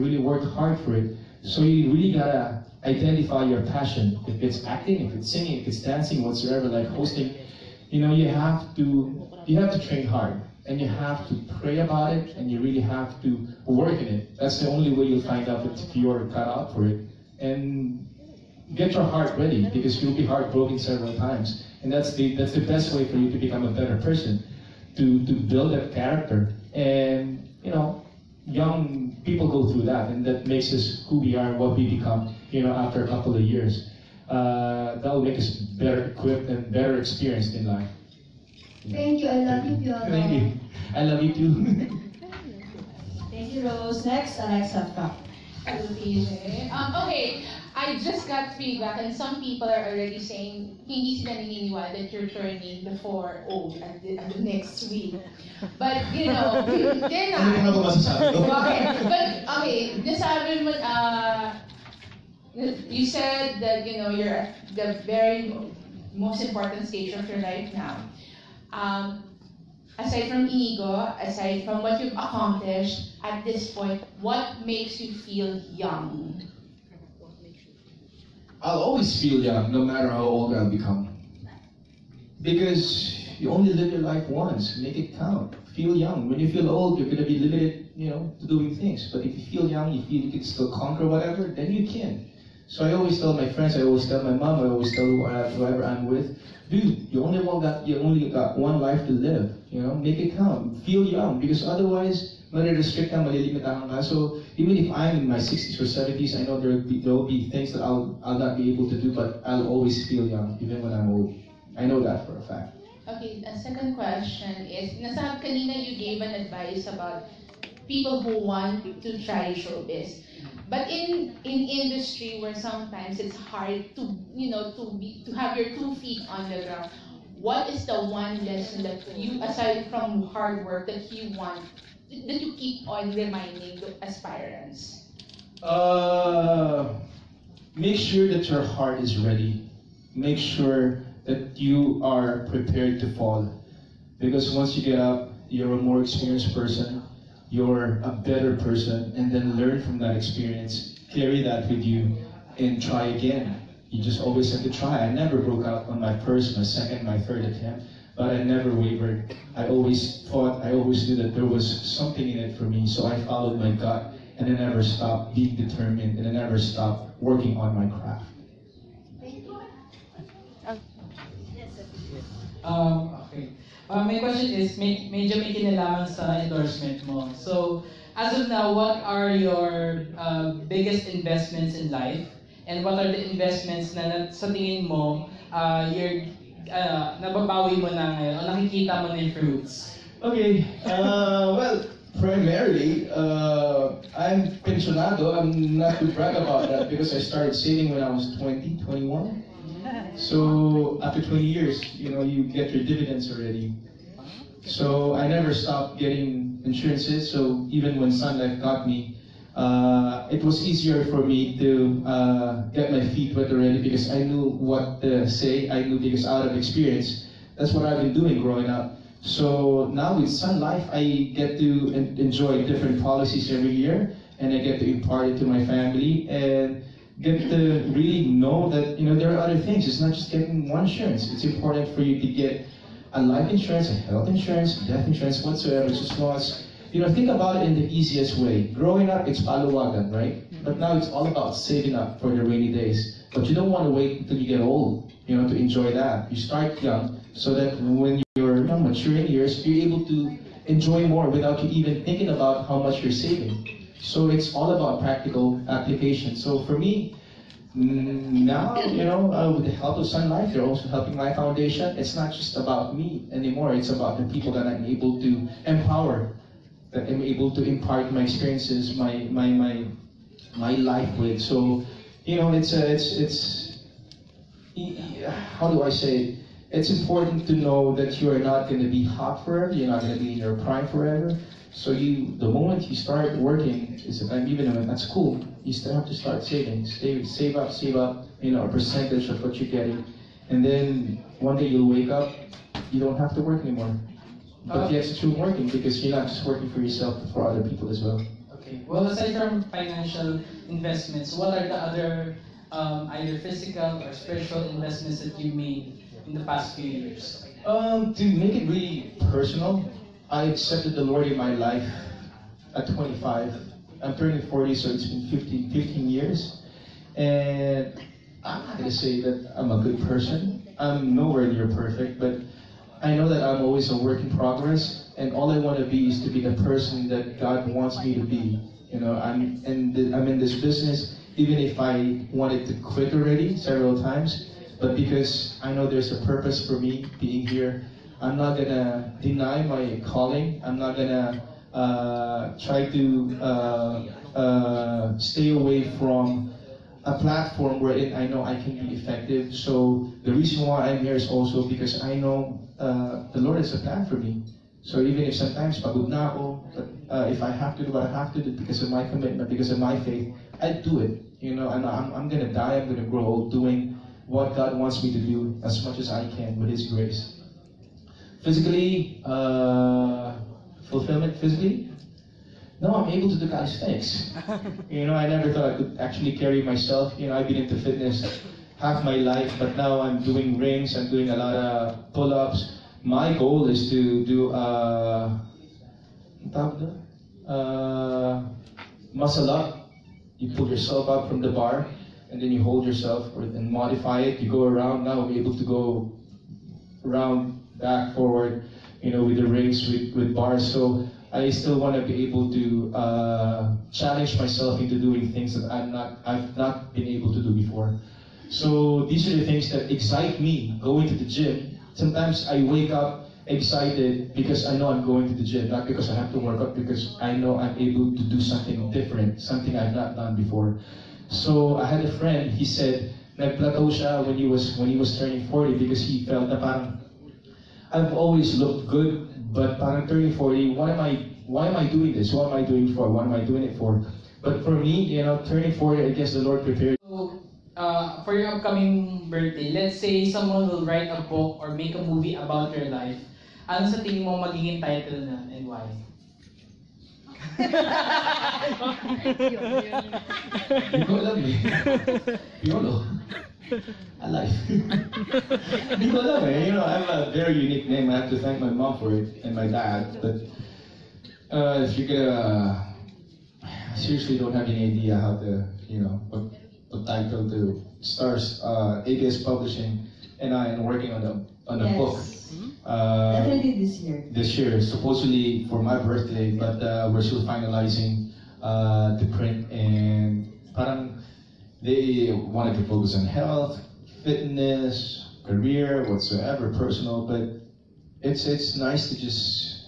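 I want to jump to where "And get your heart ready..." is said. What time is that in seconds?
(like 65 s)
17 s.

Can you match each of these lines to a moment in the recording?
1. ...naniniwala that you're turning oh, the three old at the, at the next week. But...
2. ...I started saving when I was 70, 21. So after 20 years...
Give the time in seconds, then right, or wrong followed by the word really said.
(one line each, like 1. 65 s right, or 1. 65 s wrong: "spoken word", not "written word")
1. 51 s wrong: "four", not "three"
2. 197 s wrong: "20", not "70".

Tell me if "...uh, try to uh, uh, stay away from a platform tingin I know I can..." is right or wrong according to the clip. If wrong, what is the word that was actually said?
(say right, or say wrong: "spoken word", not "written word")
wrong: "wherein", not "tingin".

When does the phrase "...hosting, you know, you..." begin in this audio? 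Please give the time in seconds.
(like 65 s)
6 s.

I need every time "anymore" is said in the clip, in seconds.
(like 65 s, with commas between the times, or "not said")
263 s, 293 s.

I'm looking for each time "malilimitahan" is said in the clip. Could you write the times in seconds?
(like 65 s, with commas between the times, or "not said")
103 s.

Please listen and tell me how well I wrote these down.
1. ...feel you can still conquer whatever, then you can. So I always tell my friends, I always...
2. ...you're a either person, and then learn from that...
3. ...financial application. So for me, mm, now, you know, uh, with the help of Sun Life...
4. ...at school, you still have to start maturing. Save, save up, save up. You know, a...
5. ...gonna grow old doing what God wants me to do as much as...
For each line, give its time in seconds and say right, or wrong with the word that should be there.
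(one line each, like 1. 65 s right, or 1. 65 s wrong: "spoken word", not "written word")
1. 90 s right
2. 147 s wrong: "better", not "either"
3. 255 s wrong: "practical", not "financial"
4. 284 s wrong: "saving", not "maturing"
5. 362 s right.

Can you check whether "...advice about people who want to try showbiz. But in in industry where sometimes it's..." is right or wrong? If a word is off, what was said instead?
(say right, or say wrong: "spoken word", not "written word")
right.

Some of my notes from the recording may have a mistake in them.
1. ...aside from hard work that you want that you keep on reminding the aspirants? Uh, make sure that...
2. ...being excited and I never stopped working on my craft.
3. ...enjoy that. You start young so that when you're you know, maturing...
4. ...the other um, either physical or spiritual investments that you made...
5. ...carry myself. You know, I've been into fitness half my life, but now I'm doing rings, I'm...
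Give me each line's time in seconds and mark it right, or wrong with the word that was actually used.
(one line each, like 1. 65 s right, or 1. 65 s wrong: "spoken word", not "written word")
1. 129 s right
2. 165 s wrong: "determined", not "excited"
3. 245 s right
4. 301 s right
5. 376 s right.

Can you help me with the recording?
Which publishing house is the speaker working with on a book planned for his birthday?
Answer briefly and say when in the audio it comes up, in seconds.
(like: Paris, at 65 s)
ABS Publishing, at 469 s.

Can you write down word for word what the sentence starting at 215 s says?
I knew because out of experience, that's what I've been doing growing up.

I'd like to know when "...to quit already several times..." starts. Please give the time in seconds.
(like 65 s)
332 s.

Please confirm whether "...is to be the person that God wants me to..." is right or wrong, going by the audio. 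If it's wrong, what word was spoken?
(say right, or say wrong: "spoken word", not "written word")
right.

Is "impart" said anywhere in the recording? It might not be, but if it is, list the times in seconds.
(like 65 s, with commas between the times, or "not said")
224 s, 267 s.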